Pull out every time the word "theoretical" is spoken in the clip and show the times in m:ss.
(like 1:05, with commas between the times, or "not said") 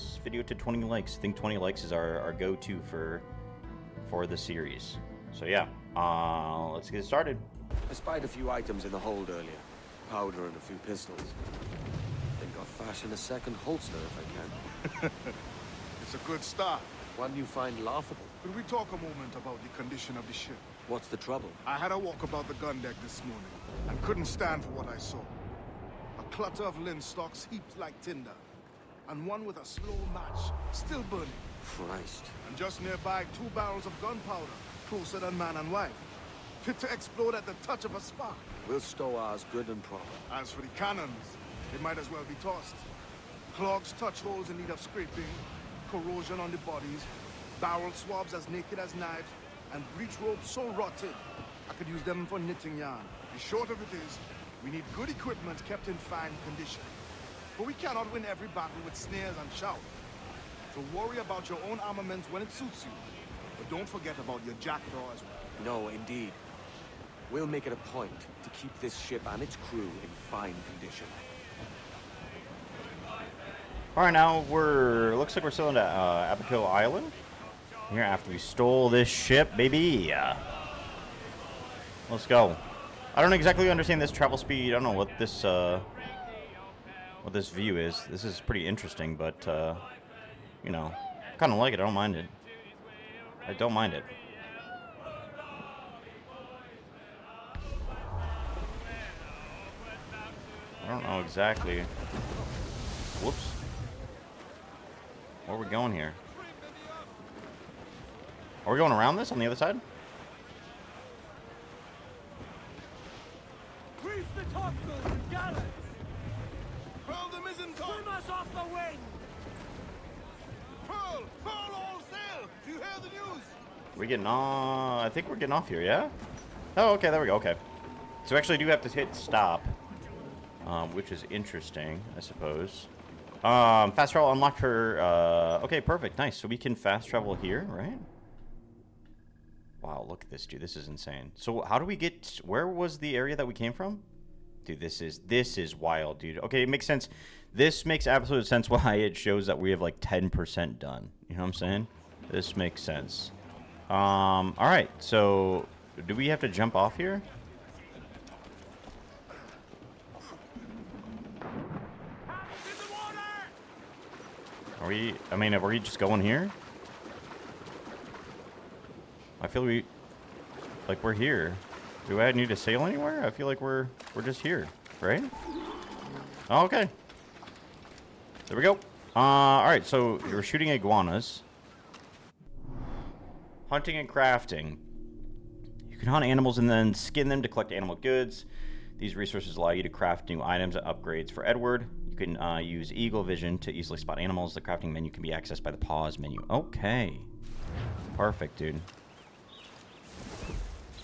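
not said.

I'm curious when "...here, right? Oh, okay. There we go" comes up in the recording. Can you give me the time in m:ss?
2:54.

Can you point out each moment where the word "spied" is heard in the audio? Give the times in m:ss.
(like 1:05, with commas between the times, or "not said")
0:07.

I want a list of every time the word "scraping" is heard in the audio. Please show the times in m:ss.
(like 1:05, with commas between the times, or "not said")
0:44.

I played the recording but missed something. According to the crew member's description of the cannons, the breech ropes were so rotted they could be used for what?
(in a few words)
Knitting yarn.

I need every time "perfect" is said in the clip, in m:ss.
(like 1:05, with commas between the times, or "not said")
2:15, 3:18.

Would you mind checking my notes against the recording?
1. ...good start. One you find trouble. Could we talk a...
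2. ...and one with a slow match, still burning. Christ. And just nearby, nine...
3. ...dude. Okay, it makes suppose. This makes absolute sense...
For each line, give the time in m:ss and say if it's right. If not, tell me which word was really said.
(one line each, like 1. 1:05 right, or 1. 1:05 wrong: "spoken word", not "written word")
1. 0:16 wrong: "laughable", not "trouble"
2. 0:29 wrong: "two", not "nine"
3. 2:26 wrong: "sense", not "suppose".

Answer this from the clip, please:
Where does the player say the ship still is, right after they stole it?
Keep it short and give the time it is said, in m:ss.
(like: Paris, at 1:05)
Abaco Island, at 1:16.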